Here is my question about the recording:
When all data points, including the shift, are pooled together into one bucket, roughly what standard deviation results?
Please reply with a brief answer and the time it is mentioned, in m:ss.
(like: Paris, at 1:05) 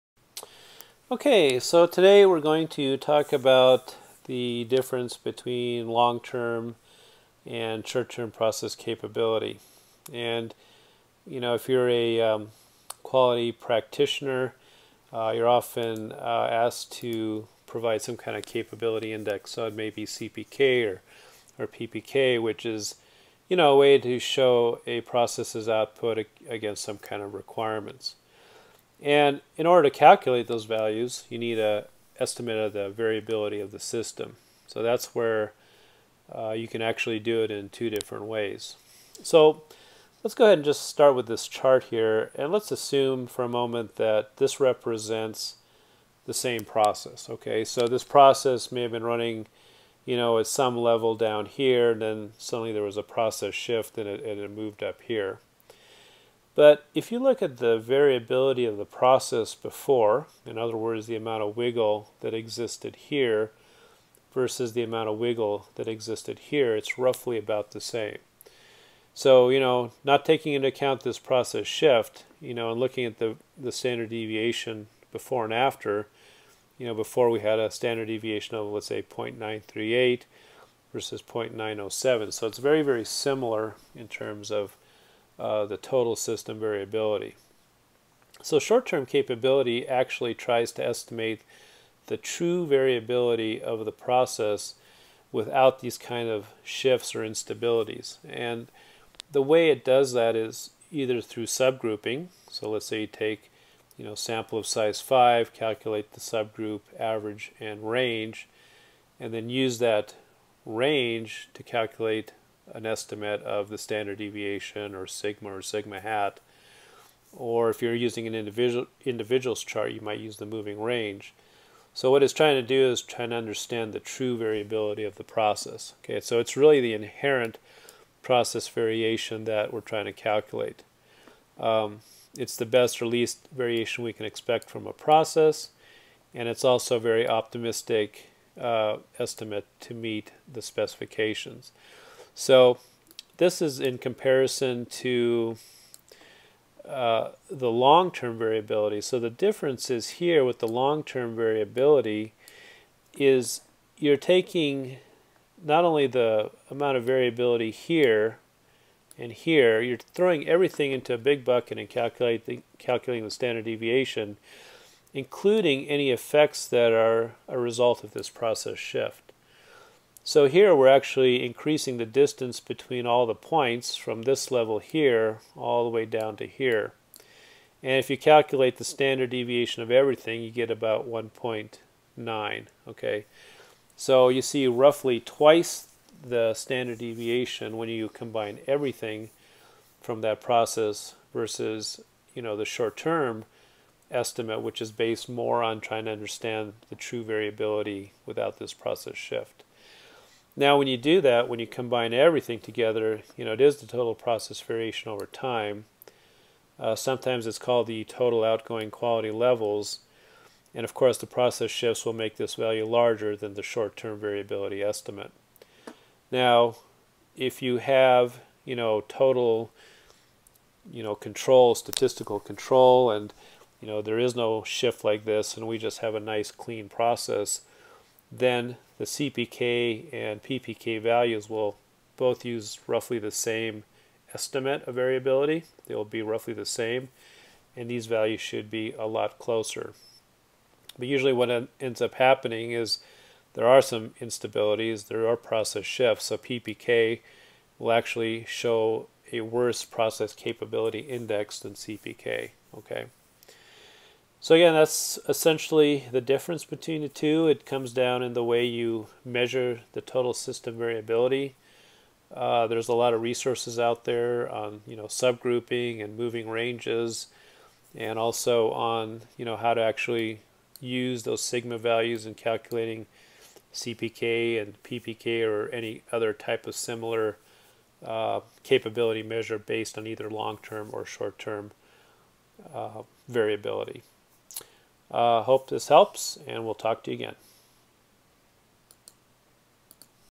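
1.9, at 3:01.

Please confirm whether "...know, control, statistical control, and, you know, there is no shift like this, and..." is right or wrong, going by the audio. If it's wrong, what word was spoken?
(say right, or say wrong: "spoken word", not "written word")
right.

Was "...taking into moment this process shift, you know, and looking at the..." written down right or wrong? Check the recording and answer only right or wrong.
wrong.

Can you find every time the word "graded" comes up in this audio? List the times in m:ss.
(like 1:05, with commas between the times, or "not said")
not said.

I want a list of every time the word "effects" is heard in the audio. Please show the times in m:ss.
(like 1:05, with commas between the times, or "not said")
2:46.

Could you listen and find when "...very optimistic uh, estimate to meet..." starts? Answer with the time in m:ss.
2:16.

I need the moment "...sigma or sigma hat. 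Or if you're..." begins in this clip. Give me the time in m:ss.
1:55.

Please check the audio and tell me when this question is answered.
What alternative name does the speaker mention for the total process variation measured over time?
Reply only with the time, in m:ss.
3:28.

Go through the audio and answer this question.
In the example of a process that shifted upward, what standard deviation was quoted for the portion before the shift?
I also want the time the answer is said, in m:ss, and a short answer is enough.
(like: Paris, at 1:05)
0.938, at 1:19.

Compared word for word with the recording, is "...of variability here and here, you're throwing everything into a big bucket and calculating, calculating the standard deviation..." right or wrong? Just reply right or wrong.
right.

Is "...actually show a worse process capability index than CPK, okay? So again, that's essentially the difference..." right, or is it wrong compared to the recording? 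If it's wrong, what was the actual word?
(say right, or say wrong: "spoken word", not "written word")
right.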